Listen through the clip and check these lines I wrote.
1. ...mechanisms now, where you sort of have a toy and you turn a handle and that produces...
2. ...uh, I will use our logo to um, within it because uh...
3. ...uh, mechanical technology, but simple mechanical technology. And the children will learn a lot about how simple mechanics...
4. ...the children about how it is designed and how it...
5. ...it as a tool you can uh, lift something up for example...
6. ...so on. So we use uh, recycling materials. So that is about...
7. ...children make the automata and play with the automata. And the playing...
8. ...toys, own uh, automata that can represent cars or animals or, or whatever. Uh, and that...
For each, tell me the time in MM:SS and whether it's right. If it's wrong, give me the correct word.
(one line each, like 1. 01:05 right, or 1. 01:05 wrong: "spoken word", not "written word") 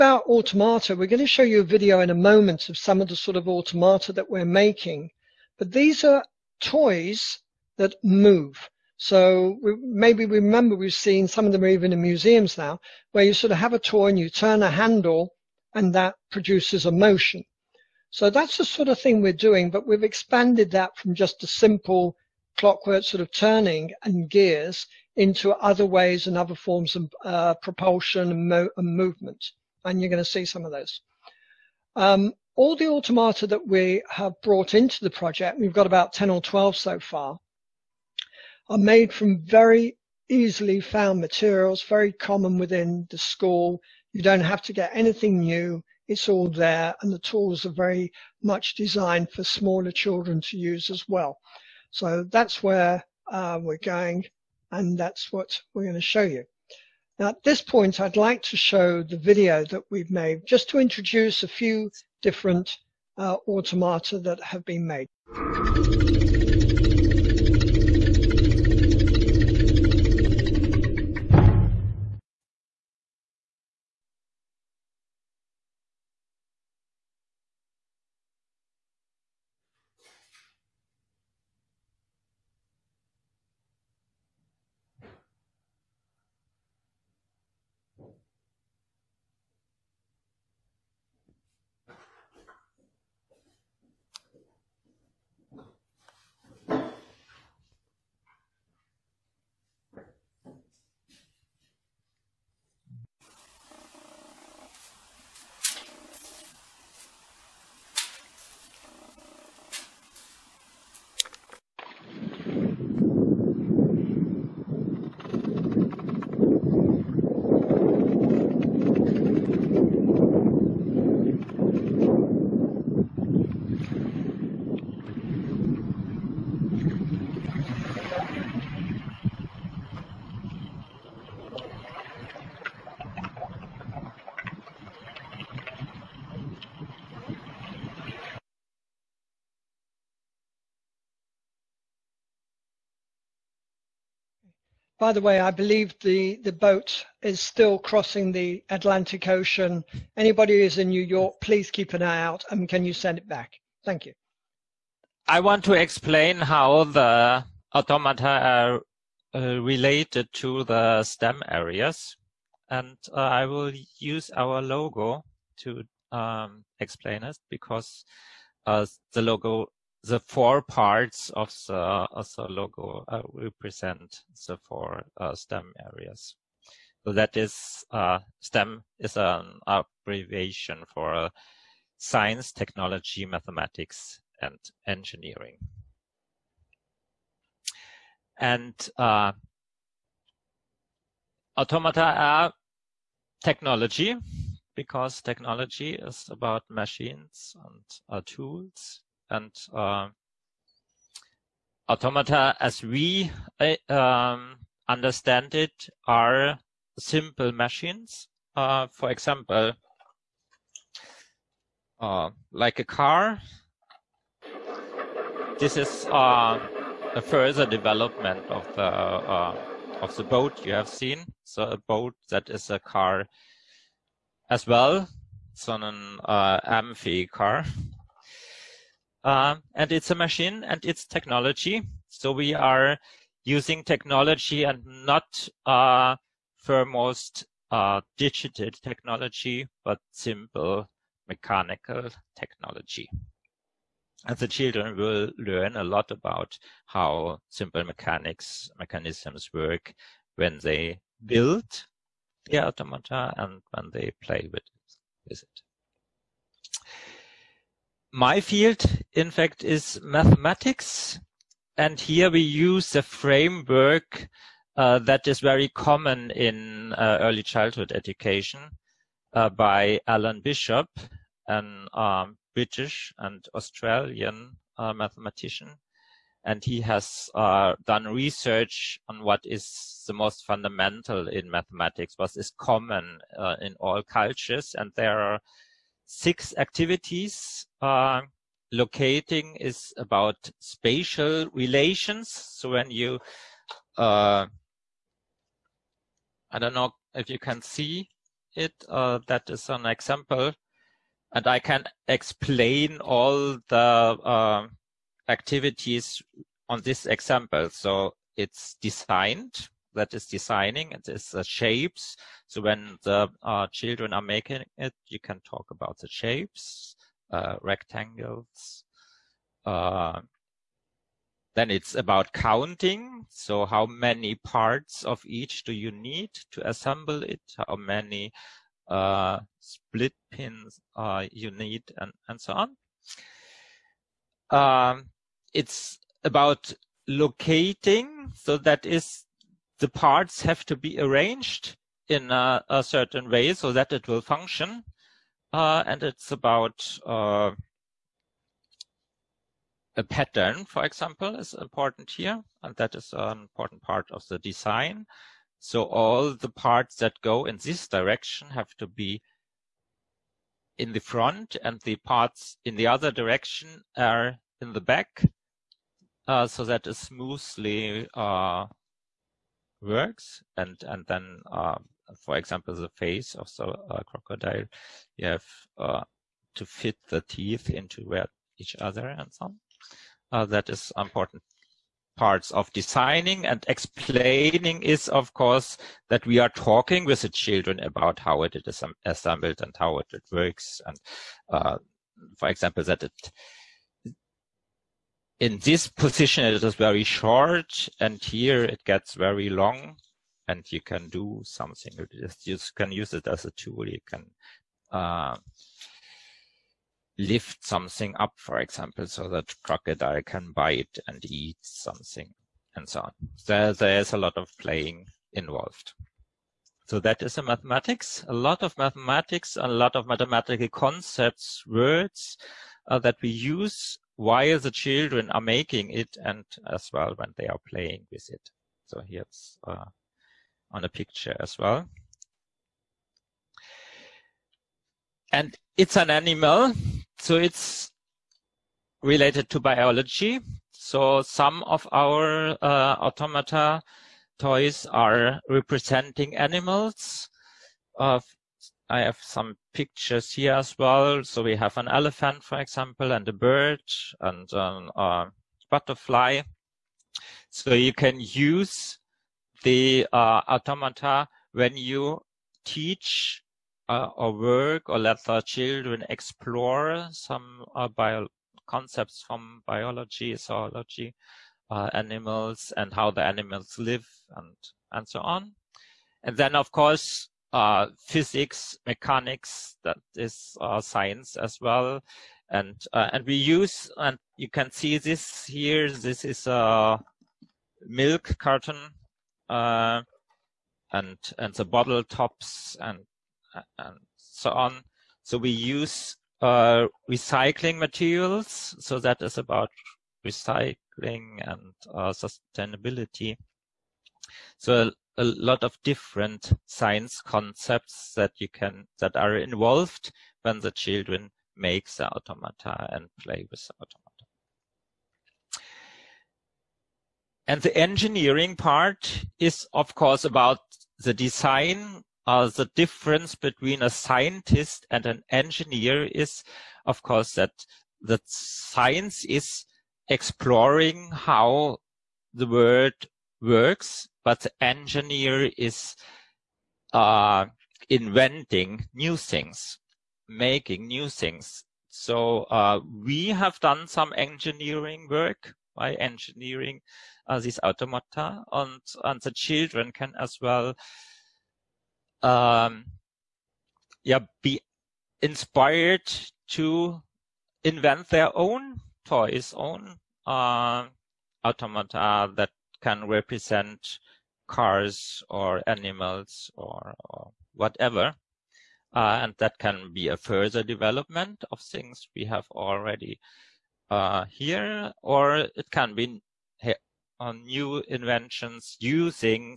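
1. 00:12 wrong: "museums", not "mechanisms"
2. 02:43 wrong: "explain", not "within"
3. 03:57 wrong: "digital", not "mechanical"
4. 06:27 wrong: "assembled", not "designed"
5. 06:43 right
6. 08:14 right
7. 08:30 wrong: "engineering", not "playing"
8. 09:19 right.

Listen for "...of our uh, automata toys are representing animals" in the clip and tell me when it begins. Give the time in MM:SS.
07:21.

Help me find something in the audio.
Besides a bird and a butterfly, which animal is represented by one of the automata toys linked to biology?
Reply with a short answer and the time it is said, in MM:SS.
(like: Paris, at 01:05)
Elephant, at 07:31.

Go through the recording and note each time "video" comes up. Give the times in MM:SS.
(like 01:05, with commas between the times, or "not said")
00:01, 00:59.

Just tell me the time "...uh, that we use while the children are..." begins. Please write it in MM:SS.
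07:02.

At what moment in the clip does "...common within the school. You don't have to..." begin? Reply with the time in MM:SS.
00:42.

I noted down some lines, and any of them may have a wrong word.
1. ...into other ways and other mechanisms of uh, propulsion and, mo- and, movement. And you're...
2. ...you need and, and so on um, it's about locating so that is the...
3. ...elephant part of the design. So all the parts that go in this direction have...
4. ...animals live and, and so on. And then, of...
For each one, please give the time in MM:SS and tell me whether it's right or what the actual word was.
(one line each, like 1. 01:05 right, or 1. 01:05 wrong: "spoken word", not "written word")
1. 00:25 wrong: "forms", not "mechanisms"
2. 05:31 right
3. 05:53 wrong: "important", not "elephant"
4. 07:53 right.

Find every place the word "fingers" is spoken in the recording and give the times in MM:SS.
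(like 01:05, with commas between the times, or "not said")
not said.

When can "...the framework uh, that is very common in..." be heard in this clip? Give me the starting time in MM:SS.
04:22.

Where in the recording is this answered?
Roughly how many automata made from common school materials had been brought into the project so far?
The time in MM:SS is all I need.
00:35.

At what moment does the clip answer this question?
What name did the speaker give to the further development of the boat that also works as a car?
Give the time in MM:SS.
03:46.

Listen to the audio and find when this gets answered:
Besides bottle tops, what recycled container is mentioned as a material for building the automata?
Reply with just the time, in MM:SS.
08:07.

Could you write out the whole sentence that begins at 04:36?
And he has uh, done research on what is the most fundamental in mathematics, what is common uh, in all cultures.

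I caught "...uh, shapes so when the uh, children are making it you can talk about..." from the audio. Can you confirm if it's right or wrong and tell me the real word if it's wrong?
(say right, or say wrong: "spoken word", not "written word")
right.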